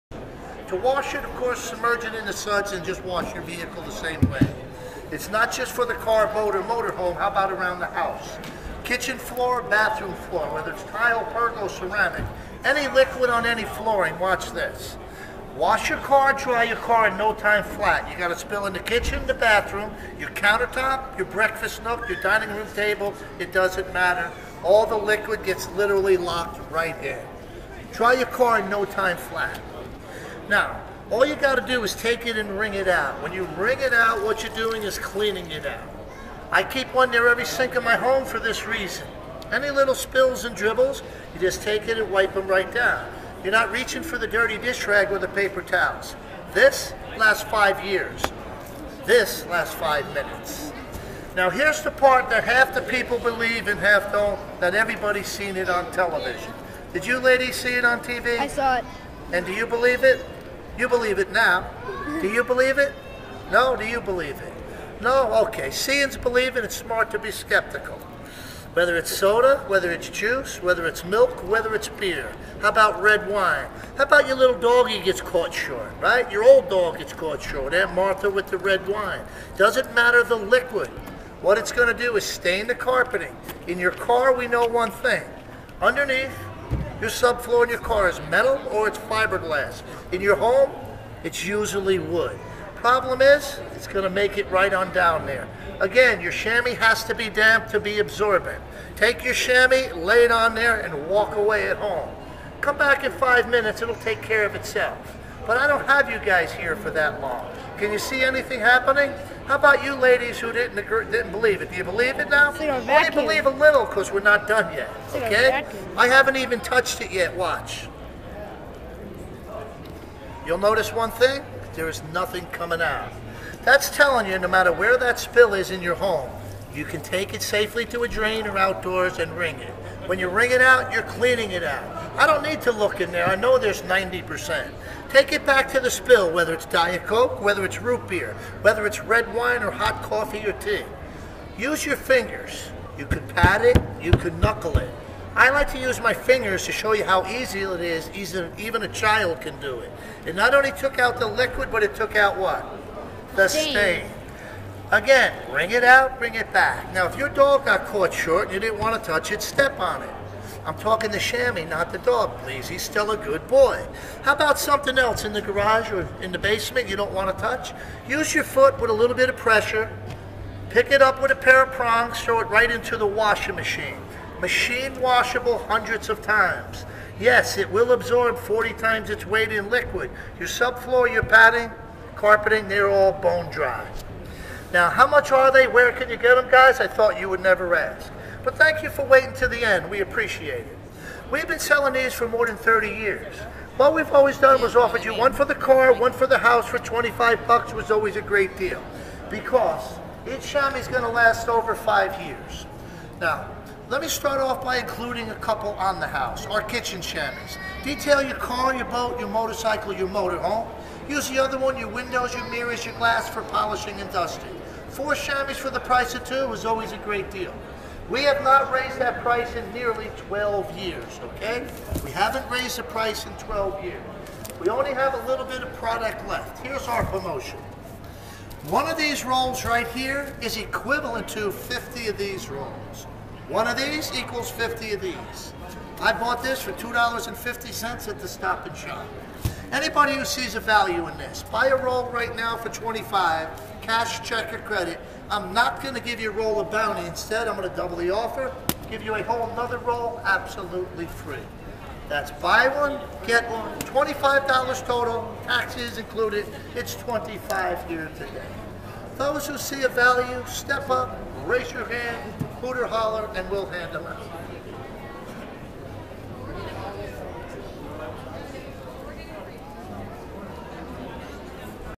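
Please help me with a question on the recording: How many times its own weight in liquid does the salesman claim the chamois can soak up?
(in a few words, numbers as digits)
40 times.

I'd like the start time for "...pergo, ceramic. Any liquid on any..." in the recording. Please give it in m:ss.
0:11.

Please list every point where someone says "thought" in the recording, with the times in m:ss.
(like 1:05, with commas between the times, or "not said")
3:06.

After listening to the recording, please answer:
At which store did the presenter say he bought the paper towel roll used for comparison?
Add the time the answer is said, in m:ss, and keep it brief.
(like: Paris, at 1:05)
Stop and Shop, at 3:58.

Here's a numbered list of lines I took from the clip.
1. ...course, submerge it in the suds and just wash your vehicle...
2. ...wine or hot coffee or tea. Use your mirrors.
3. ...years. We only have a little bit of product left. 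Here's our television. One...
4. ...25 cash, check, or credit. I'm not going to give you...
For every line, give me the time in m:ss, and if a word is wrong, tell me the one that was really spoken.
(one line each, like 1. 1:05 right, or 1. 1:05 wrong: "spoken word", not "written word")
1. 0:01 right
2. 2:19 wrong: "fingers", not "mirrors"
3. 3:43 wrong: "promotion", not "television"
4. 4:02 right.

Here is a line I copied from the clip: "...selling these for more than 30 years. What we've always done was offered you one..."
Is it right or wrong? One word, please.
right.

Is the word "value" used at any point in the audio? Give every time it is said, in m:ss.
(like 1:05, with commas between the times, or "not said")
4:00, 4:19.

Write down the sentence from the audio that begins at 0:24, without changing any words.
All the liquid gets literally locked right in.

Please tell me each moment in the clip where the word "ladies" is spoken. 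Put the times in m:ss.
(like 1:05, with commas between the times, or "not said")
0:57, 1:49.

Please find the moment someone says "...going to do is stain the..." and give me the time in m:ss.
1:21.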